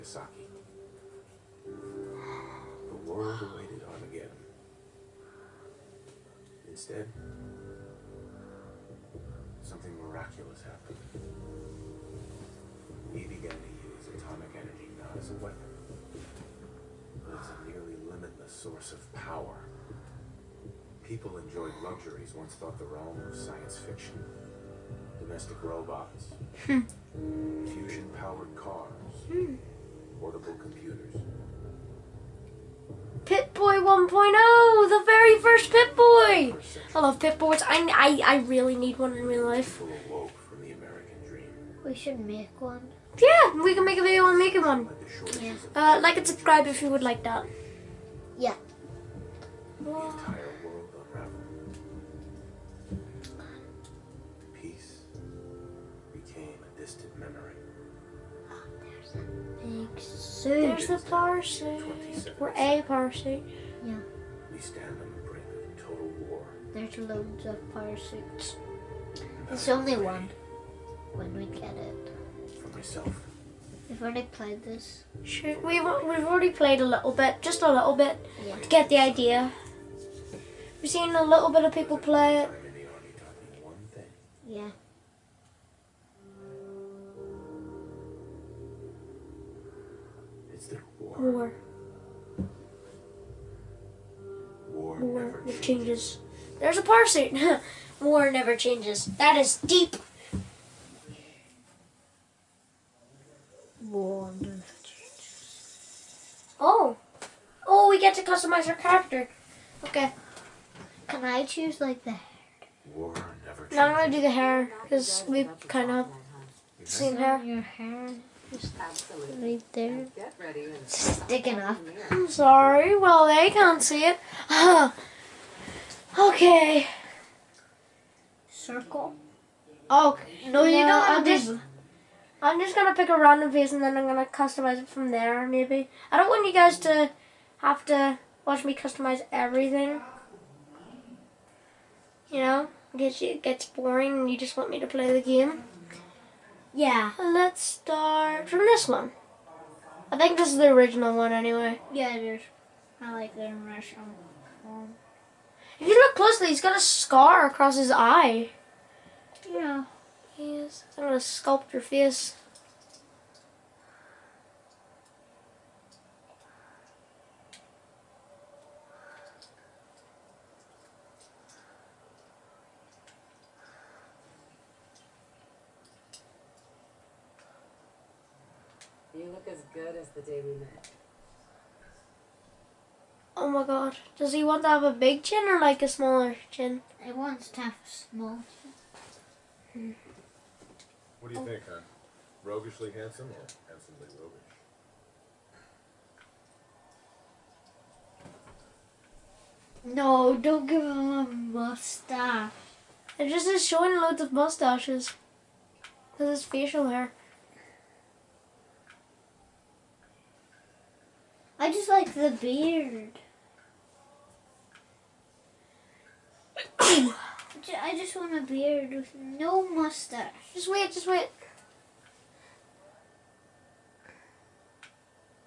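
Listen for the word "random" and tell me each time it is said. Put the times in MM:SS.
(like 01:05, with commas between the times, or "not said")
02:13.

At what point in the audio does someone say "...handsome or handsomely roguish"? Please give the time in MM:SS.
03:12.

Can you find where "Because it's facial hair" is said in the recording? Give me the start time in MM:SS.
03:26.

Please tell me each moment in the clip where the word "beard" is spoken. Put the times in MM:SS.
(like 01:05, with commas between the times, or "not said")
03:32, 03:38.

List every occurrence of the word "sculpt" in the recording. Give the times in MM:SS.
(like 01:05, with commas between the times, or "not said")
02:41.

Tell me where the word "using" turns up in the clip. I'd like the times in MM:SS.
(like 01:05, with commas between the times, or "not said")
not said.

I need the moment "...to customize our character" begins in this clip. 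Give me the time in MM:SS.
01:48.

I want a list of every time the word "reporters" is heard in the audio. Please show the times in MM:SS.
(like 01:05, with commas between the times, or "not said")
not said.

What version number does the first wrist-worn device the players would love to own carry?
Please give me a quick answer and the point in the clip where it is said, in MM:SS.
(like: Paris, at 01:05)
1.0, at 00:33.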